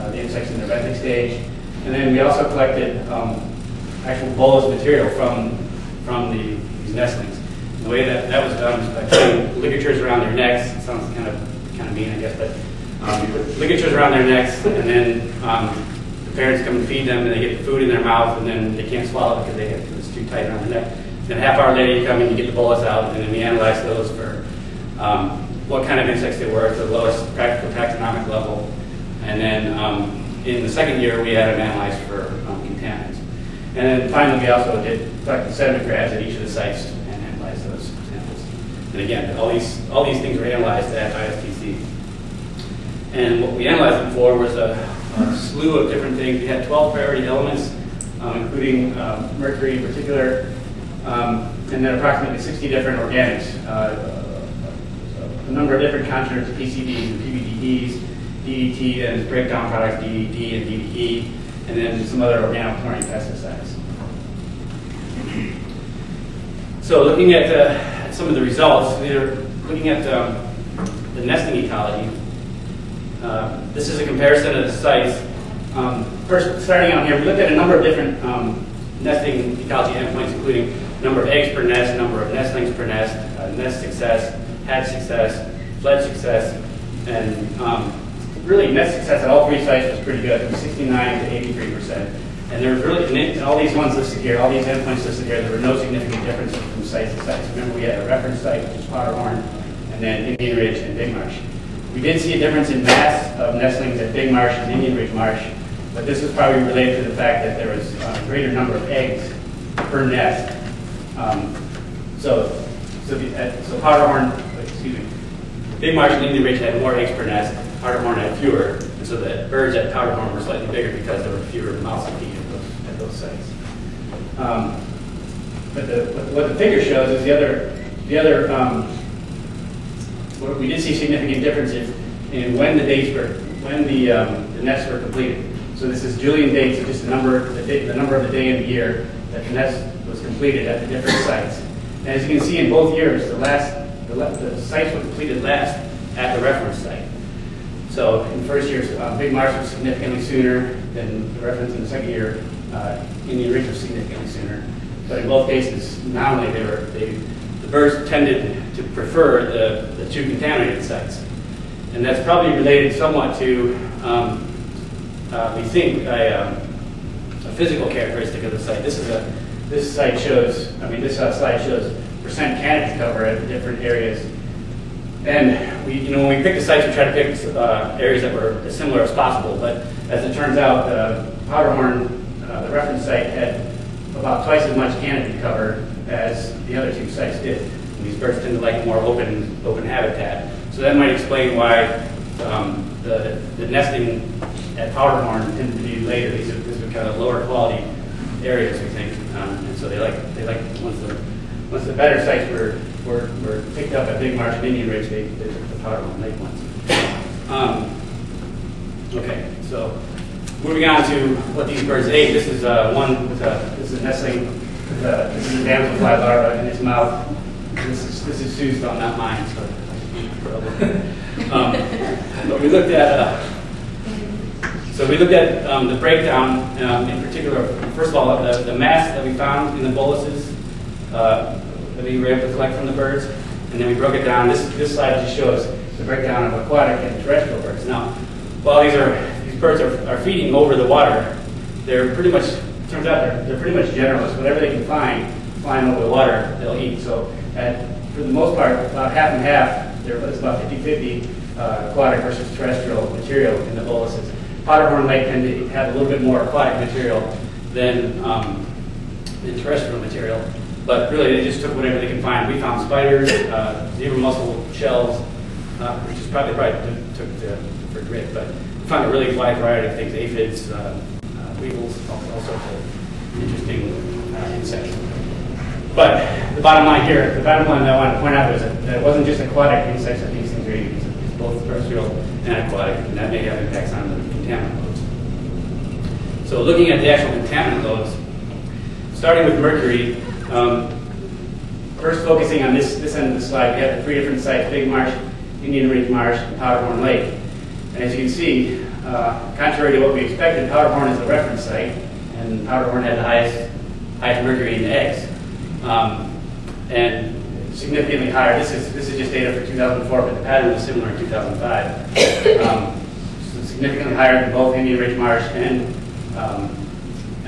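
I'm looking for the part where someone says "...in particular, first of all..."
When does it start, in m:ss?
3:47.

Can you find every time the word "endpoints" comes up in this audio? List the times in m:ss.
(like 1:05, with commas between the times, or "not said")
1:19, 1:34.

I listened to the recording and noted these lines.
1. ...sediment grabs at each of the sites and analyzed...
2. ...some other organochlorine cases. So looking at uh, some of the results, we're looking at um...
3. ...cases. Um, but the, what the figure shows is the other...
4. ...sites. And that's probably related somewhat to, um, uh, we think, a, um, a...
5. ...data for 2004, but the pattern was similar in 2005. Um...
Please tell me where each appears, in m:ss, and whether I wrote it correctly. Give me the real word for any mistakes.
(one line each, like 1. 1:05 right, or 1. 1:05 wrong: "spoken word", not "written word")
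1. 0:35 right
2. 1:02 wrong: "pesticides", not "cases"
3. 2:03 wrong: "sites", not "cases"
4. 2:40 right
5. 5:09 right.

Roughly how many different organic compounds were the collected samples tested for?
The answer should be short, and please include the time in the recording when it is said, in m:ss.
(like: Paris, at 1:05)
60, at 0:51.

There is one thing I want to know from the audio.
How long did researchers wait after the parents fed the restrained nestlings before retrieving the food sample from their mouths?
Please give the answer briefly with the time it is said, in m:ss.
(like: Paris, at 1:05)
half hour, at 0:21.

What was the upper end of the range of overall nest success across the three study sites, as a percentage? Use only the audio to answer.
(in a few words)
83 percent.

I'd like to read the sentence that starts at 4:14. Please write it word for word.
Powderhorn Lake tended to have a little bit more aquatic material than, um, than terrestrial material.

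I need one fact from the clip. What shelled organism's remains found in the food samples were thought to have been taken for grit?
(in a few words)
zebra mussel.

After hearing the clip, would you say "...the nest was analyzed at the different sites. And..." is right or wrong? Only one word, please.
wrong.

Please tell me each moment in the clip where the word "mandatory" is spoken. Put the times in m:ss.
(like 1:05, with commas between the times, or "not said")
not said.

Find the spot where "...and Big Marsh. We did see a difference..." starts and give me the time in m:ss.
1:40.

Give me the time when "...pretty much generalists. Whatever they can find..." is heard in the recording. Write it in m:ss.
4:03.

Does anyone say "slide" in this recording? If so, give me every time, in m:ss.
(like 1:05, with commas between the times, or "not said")
2:51, 3:54, 4:53.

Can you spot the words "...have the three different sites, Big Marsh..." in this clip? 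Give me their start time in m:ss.
4:53.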